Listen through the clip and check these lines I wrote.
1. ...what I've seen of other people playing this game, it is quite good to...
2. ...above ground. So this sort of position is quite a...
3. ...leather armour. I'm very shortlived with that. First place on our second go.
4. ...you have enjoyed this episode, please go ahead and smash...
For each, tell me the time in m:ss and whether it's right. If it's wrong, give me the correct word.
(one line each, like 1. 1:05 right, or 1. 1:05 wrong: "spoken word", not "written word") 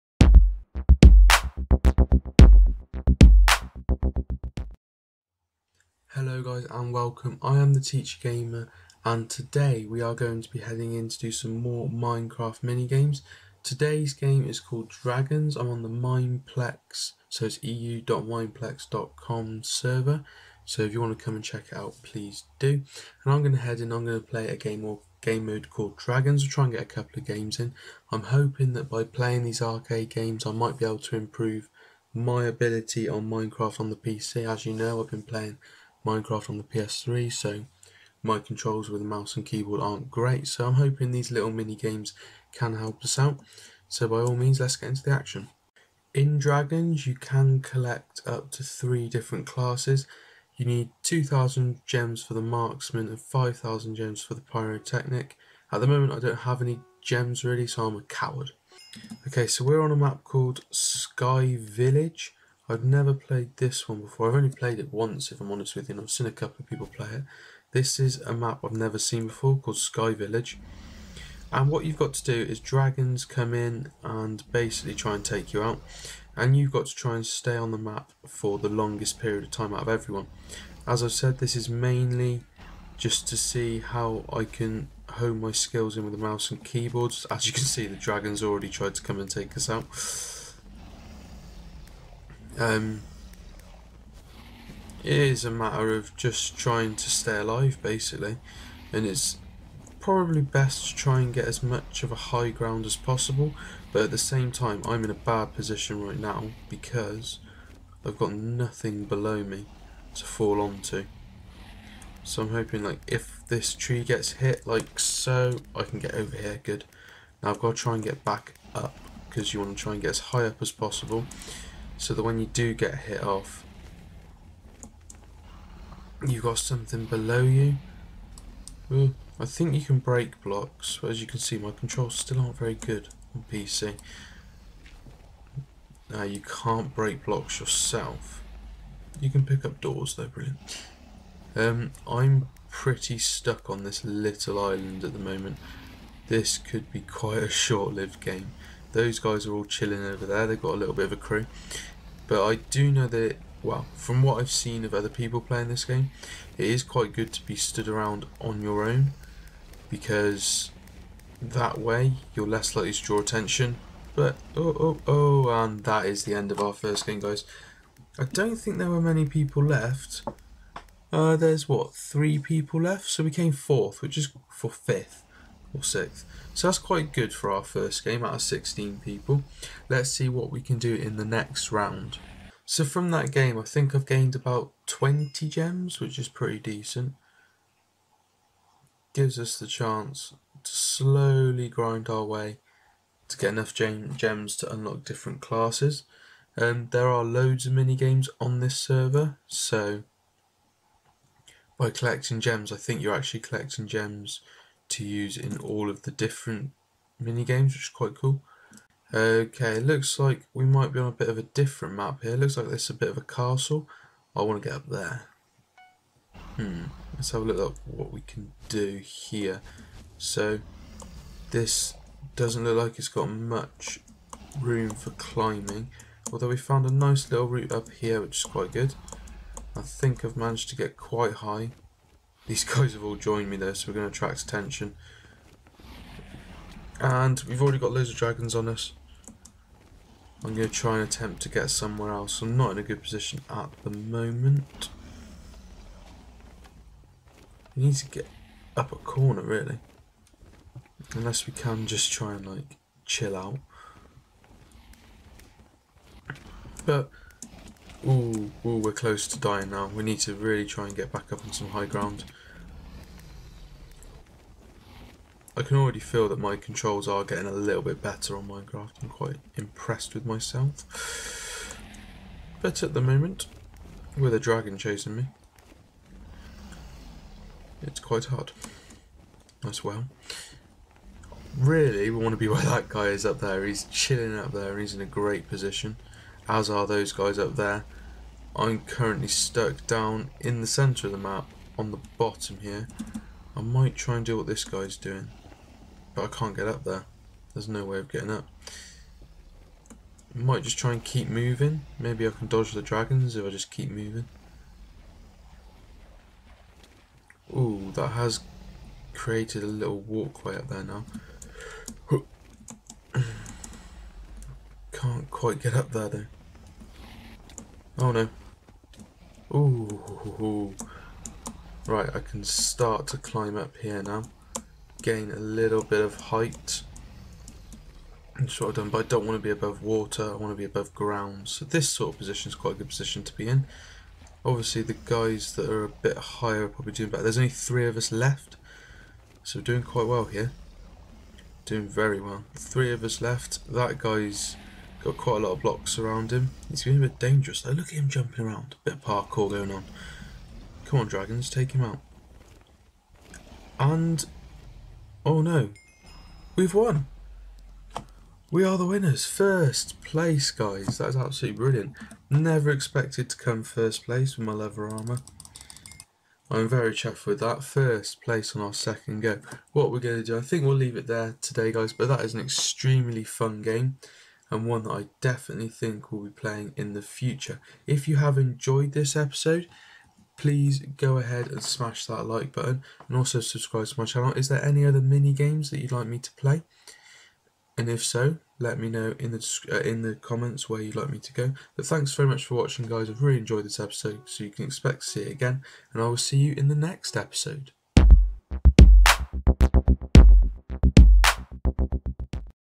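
1. 2:34 right
2. 5:30 right
3. 6:04 wrong: "chuffed", not "shortlived"
4. 6:18 right.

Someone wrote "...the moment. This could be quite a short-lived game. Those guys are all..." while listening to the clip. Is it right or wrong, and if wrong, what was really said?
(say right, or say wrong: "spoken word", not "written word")
right.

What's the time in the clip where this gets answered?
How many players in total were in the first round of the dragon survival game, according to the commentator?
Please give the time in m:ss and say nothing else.
2:58.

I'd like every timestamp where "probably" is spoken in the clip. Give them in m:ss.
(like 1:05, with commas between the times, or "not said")
1:39, 5:36.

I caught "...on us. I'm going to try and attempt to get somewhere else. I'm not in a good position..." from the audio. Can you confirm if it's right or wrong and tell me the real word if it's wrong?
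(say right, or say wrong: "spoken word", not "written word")
right.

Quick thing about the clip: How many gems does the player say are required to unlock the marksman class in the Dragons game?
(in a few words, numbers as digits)
2,000.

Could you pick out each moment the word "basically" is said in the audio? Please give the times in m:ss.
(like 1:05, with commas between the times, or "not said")
1:14, 1:37.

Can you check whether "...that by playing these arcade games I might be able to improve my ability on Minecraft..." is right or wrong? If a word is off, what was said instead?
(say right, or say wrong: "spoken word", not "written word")
right.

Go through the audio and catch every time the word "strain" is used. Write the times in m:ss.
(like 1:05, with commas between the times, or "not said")
not said.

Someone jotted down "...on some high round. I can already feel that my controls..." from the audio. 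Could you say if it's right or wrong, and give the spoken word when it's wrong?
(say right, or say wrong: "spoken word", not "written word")
wrong: "ground", not "round".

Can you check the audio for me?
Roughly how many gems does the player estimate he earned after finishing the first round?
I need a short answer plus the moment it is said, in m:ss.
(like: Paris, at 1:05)
20, at 3:04.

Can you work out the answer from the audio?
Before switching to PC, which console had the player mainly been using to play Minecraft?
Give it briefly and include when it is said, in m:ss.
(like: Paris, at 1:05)
PS3, at 0:36.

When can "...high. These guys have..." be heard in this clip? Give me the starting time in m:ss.
3:51.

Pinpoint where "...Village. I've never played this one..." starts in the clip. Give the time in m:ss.
1:01.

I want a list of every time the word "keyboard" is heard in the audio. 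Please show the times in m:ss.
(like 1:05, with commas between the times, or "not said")
0:39, 1:26.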